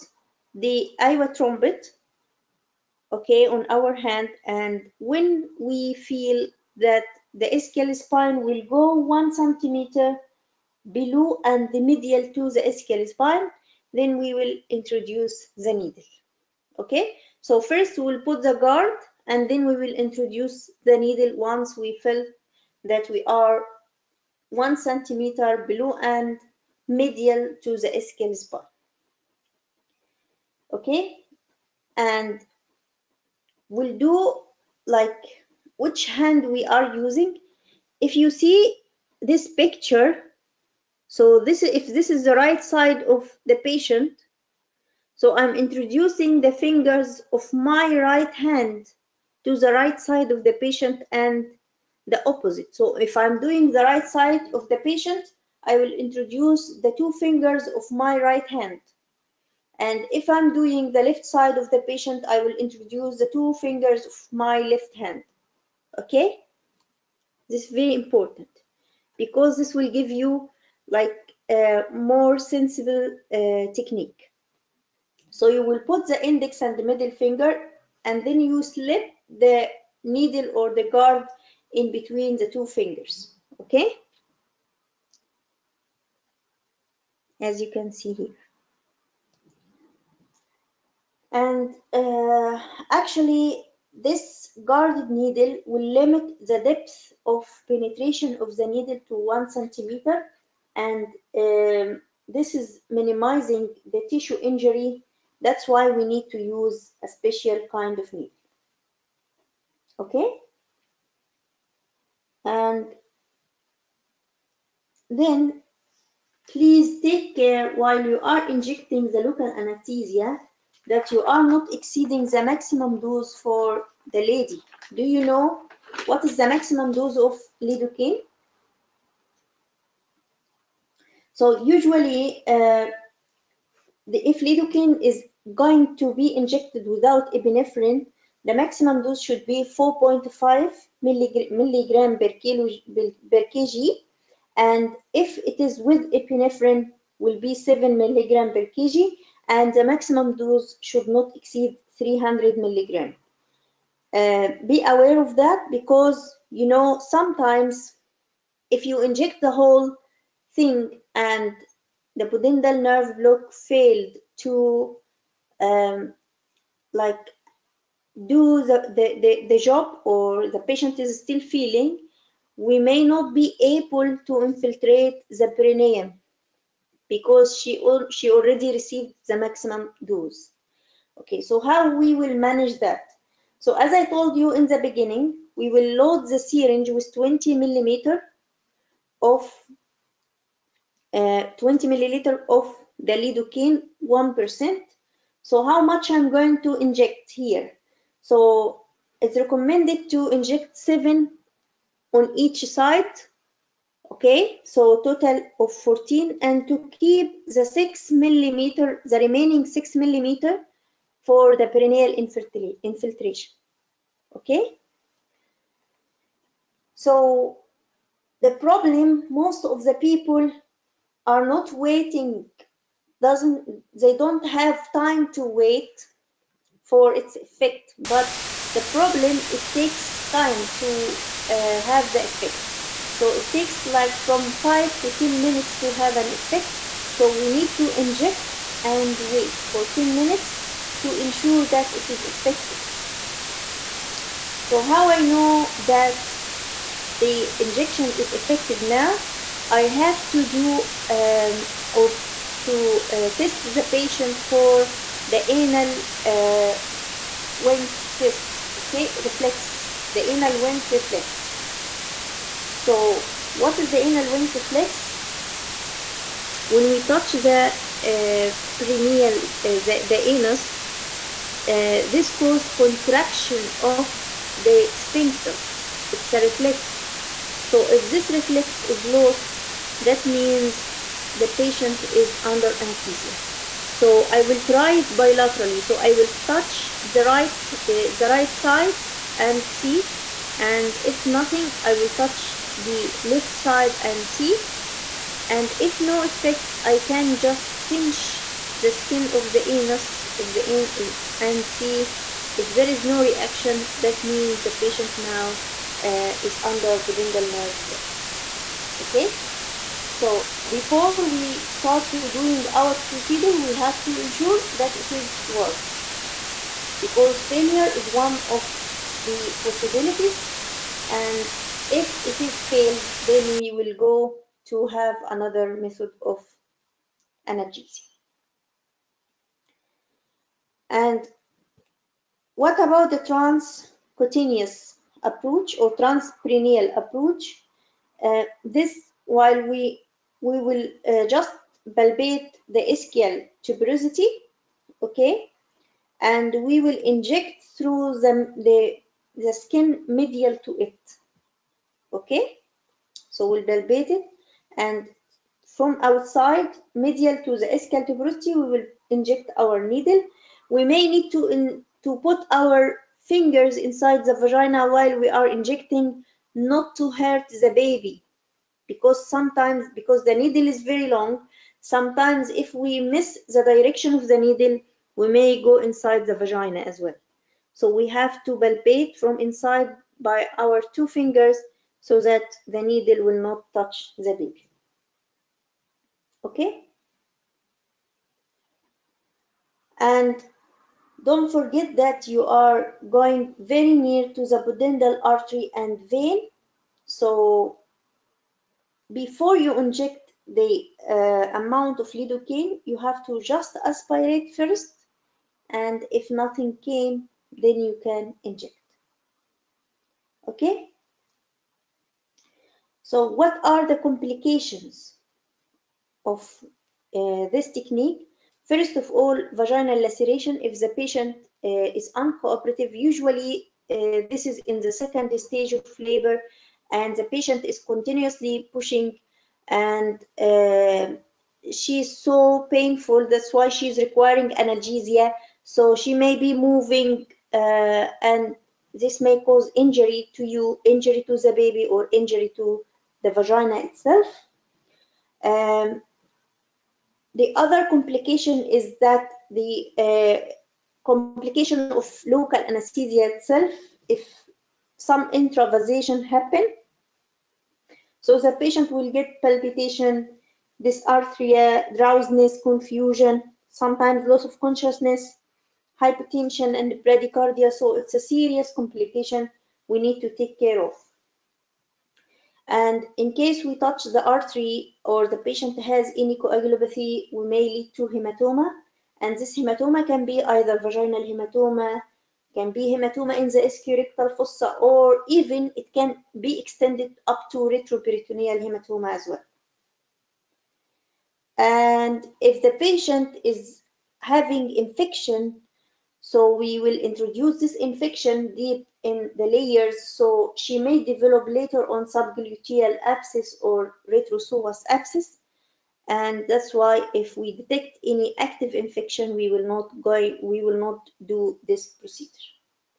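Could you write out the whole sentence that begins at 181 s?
Okay, so how we will manage that?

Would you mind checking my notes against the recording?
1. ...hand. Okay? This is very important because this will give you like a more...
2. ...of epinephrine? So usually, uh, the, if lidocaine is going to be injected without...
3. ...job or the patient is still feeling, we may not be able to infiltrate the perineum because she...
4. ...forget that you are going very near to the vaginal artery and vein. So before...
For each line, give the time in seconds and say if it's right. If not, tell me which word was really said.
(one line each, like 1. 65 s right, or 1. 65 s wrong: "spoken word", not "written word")
1. 64 s right
2. 127 s wrong: "lidocaine", not "epinephrine"
3. 169 s right
4. 391 s wrong: "pudendal", not "vaginal".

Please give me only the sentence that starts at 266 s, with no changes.
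When we touch the uh, perineal, uh, the, the, anus, uh, this causes contraction of the sphincter.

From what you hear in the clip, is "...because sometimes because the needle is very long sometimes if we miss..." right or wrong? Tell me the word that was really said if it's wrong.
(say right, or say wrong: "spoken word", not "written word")
right.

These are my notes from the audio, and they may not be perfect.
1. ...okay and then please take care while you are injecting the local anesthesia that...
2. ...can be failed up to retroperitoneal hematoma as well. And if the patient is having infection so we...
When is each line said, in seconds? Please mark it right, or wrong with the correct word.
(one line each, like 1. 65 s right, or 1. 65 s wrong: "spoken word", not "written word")
1. 110 s right
2. 485 s wrong: "extended", not "failed".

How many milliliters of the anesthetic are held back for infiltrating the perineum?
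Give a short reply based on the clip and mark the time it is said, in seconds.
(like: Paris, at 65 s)
6, at 209 s.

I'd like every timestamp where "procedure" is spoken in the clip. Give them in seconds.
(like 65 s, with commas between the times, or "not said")
313 s, 512 s.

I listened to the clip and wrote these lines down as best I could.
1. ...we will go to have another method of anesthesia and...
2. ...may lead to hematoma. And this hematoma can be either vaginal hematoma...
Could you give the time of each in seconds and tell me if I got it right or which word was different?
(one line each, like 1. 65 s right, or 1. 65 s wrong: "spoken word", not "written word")
1. 323 s wrong: "analgesia", not "anesthesia"
2. 477 s right.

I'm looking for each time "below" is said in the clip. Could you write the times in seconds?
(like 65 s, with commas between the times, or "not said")
10 s, 25 s.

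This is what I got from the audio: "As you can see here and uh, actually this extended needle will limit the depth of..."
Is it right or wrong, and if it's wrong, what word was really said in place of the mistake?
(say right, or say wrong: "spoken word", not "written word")
wrong: "guarded", not "extended".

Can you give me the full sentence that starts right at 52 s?
So if I'm doing the right side of the patient, I will introduce the two fingers of my right hand.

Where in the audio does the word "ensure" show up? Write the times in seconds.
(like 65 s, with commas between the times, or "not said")
241 s, 314 s.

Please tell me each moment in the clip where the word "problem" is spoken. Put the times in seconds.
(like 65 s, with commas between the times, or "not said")
218 s, 228 s.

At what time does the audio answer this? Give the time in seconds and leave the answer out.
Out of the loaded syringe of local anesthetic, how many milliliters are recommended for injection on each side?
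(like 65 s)
200 s.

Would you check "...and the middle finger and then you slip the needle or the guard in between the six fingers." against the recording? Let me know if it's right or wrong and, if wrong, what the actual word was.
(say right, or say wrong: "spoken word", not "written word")
wrong: "two", not "six".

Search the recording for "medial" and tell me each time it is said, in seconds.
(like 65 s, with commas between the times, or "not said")
11 s, 26 s, 350 s, 357 s.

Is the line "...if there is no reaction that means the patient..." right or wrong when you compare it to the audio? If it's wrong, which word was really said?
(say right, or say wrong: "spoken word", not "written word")
right.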